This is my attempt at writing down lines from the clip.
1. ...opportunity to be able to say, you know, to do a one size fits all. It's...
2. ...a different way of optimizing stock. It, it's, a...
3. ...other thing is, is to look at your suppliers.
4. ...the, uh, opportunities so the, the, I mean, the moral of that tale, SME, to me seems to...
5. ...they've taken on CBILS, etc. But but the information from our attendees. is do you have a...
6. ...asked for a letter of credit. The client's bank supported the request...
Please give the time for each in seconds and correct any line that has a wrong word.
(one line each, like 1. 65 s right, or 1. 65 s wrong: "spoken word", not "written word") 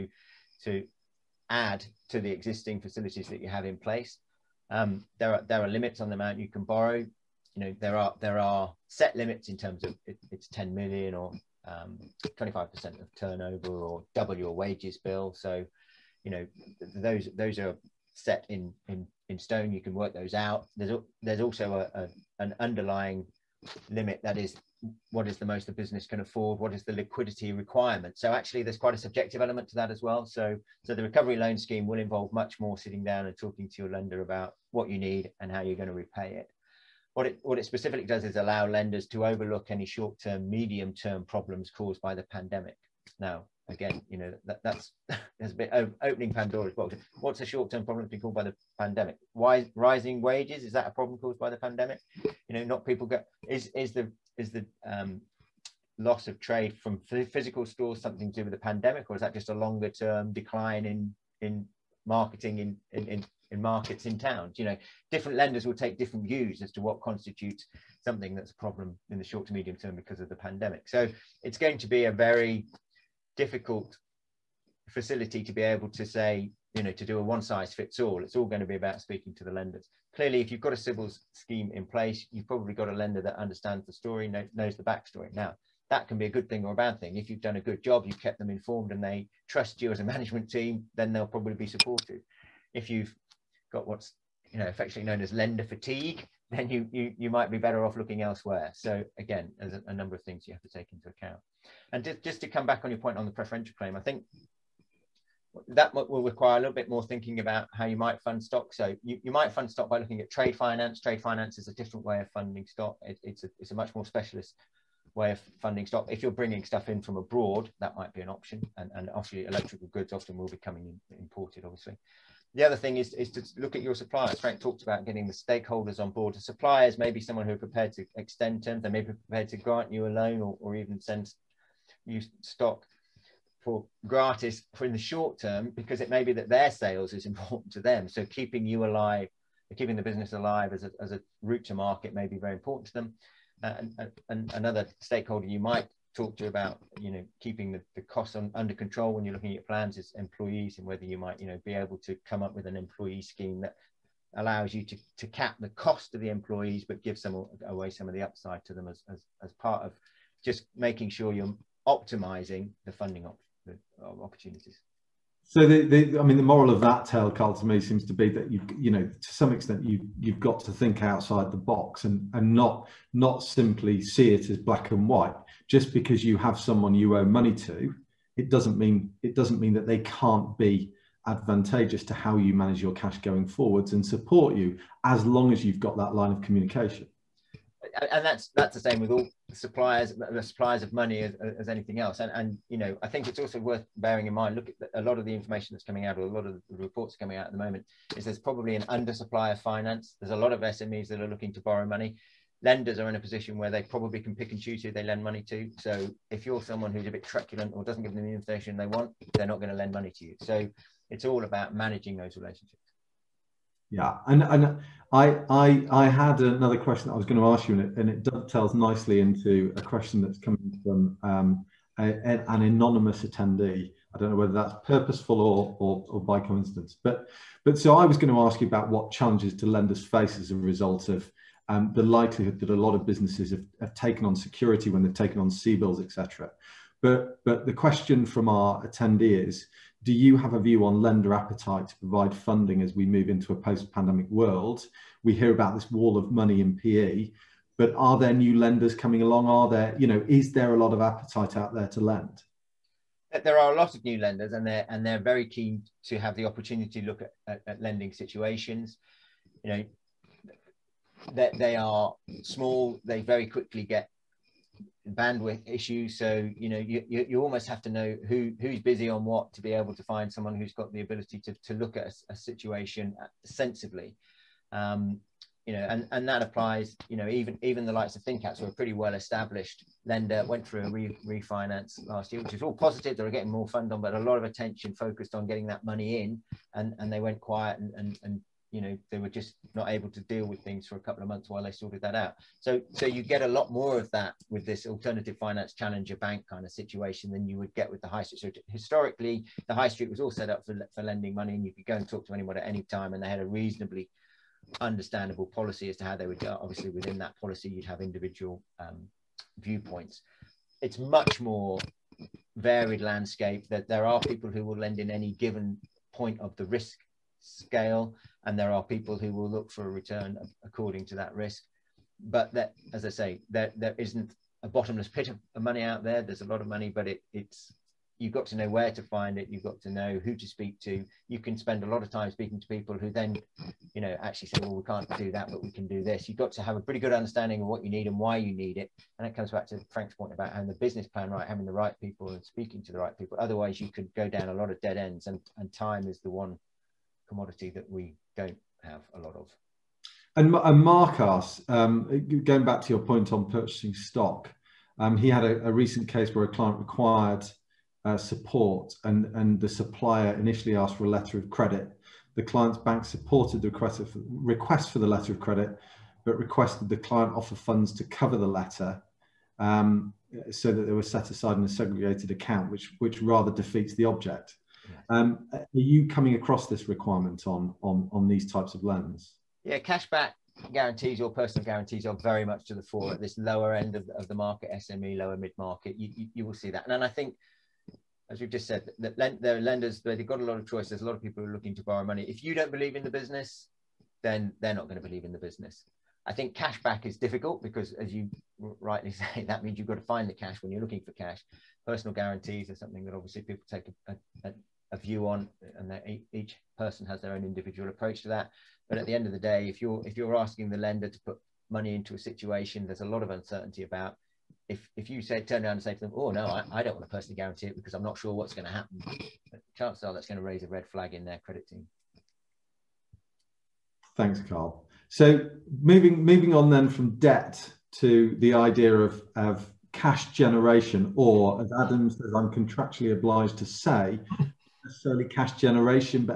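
1. 74 s wrong: "facility", not "opportunity"
2. 111 s wrong: "funding", not "optimizing"
3. 122 s right
4. 163 s wrong: "Carl", not "SME"
5. 235 s wrong: "question", not "information"
6. 360 s right.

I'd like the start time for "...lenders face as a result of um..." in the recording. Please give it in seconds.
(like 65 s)
229 s.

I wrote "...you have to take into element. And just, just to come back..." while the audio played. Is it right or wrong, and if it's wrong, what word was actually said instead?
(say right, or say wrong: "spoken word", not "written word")
wrong: "account", not "element".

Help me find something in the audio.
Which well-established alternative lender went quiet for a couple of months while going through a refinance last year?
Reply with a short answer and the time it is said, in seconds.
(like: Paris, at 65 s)
ThinCats, at 278 s.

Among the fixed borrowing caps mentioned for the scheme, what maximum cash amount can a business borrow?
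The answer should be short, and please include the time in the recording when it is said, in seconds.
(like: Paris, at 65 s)
10 million, at 10 s.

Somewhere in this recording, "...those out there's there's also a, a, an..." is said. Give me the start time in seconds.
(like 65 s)
20 s.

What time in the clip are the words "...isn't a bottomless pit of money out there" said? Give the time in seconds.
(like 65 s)
323 s.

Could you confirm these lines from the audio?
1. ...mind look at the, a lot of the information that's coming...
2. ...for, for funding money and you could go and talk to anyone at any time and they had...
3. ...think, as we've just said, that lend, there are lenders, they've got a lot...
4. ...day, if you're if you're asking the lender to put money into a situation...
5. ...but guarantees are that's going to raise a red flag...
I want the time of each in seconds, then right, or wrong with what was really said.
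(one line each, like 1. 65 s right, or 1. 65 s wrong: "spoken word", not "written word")
1. 194 s right
2. 300 s wrong: "lending", not "funding"
3. 387 s right
4. 409 s right
5. 419 s wrong: "chances", not "guarantees".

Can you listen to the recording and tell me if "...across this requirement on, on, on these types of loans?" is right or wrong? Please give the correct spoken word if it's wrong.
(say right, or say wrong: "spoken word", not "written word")
right.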